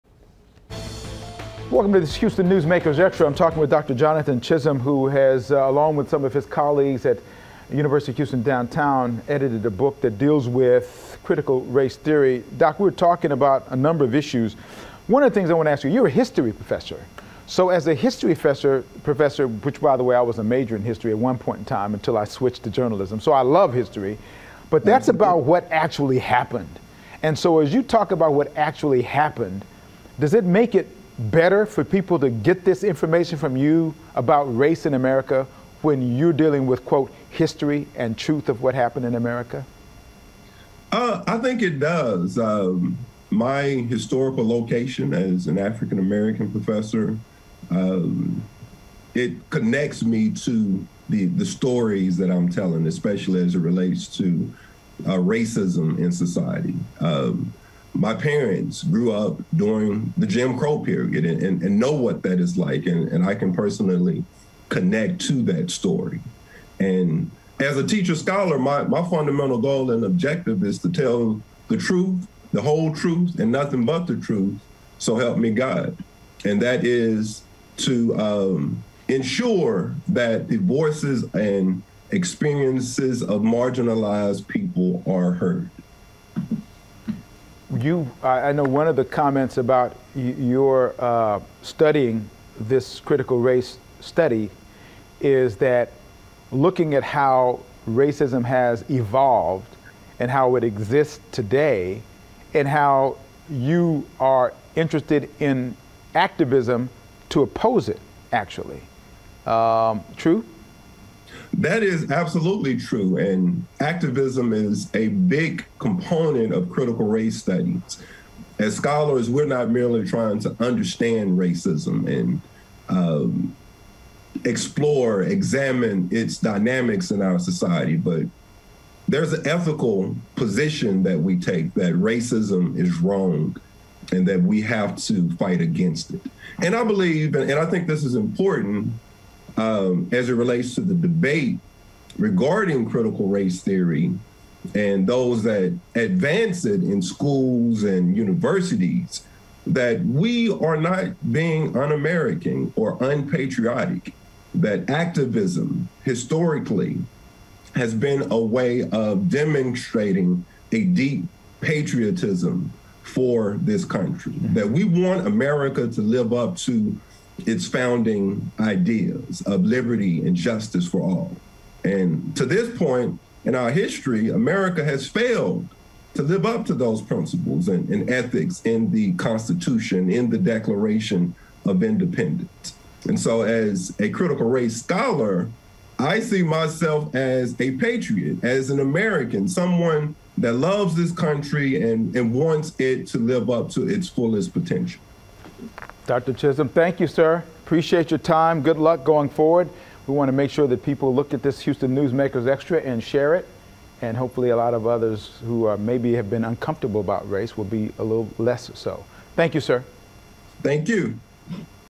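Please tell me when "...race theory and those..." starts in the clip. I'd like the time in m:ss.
2:23.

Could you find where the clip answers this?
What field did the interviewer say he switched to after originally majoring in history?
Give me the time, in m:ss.
0:22.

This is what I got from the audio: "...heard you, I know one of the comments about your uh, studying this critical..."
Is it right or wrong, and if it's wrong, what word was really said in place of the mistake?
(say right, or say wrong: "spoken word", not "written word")
right.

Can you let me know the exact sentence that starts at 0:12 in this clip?
Doc, we are talking about a number of issues.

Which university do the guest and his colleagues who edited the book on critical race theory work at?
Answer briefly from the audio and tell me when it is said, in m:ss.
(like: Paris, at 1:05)
University of Houston Downtown, at 0:07.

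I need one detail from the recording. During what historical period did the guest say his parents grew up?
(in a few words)
Jim Crow.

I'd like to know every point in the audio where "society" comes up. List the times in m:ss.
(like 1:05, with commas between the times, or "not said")
0:56, 2:07.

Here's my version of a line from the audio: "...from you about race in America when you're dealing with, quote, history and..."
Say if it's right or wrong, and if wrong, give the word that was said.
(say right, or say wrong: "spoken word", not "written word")
right.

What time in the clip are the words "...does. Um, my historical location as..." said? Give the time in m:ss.
0:41.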